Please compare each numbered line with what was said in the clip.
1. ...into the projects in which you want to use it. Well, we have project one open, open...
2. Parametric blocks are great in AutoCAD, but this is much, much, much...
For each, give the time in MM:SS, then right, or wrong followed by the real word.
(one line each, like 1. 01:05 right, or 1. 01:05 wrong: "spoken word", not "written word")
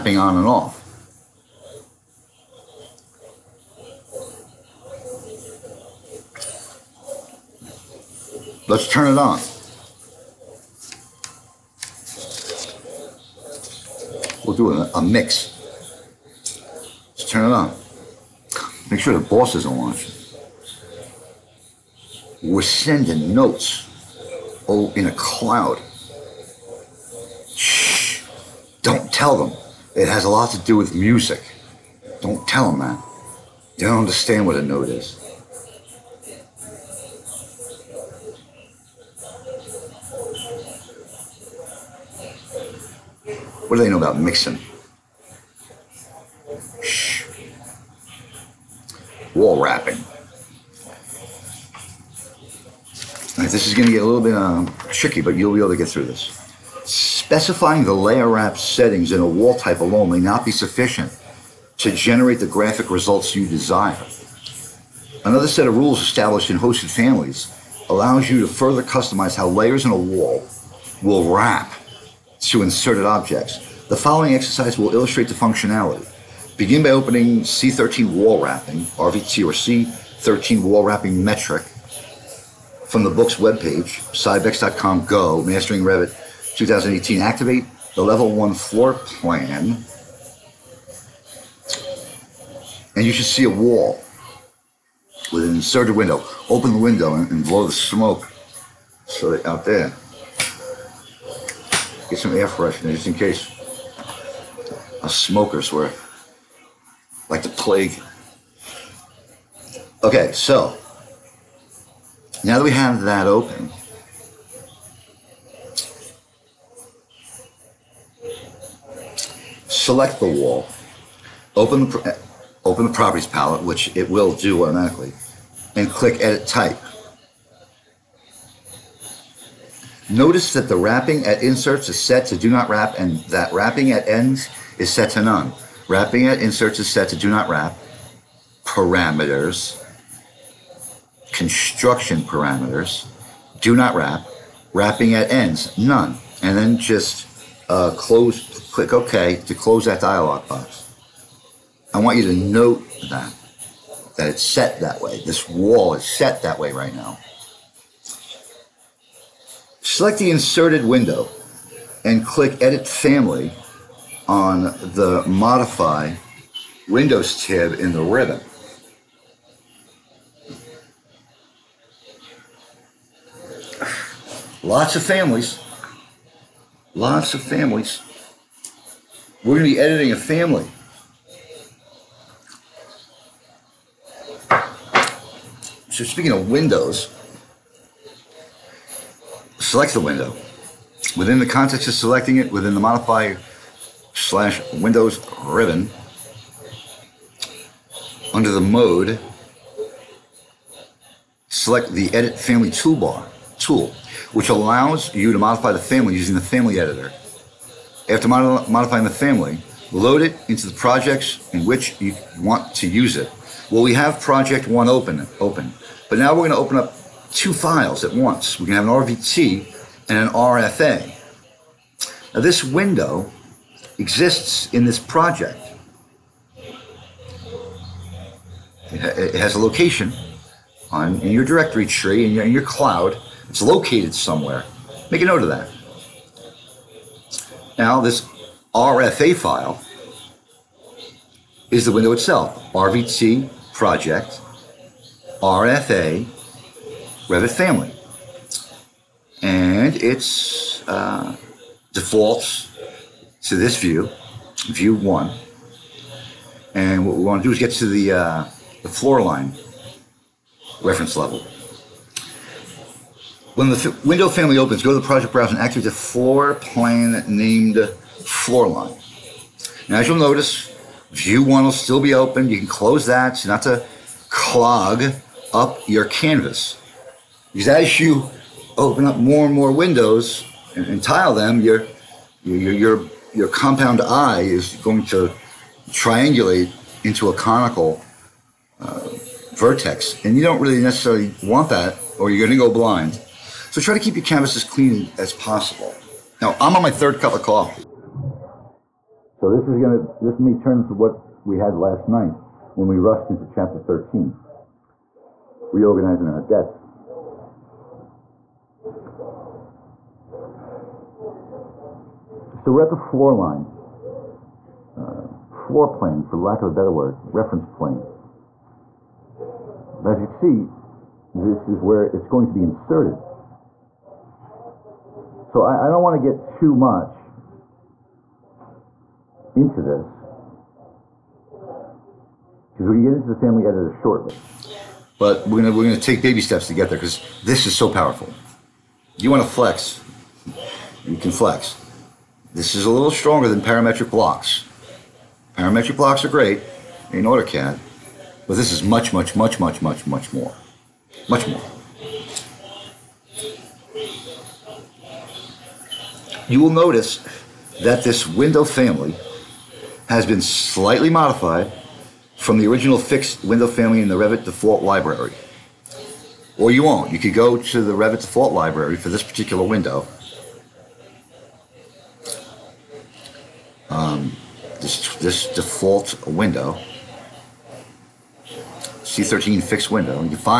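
1. 03:30 right
2. 05:45 right.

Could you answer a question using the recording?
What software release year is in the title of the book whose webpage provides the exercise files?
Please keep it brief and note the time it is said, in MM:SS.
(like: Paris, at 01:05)
2018, at 01:25.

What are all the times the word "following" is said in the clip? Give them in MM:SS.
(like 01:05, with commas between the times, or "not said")
01:13.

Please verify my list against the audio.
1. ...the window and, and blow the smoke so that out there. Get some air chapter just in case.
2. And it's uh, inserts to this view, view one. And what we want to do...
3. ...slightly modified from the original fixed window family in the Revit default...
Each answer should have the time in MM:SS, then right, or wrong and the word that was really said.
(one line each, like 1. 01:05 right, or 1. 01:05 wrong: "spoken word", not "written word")
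1. 01:36 wrong: "freshener", not "chapter"
2. 04:09 wrong: "defaults", not "inserts"
3. 06:00 right.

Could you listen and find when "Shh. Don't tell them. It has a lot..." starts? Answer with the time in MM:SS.
00:27.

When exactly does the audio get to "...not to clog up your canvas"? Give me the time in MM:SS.
04:33.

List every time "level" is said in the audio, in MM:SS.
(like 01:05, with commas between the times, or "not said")
01:28, 04:21.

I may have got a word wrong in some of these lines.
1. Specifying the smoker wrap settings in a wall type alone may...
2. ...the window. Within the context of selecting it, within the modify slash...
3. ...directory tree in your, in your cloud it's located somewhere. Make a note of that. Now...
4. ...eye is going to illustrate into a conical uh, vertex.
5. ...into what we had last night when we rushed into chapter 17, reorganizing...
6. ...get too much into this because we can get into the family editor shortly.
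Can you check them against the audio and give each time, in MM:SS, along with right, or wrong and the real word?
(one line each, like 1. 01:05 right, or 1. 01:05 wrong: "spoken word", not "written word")
1. 00:56 wrong: "layer", not "smoker"
2. 03:09 right
3. 03:51 right
4. 04:44 wrong: "triangulate", not "illustrate"
5. 05:00 wrong: "13", not "17"
6. 05:26 right.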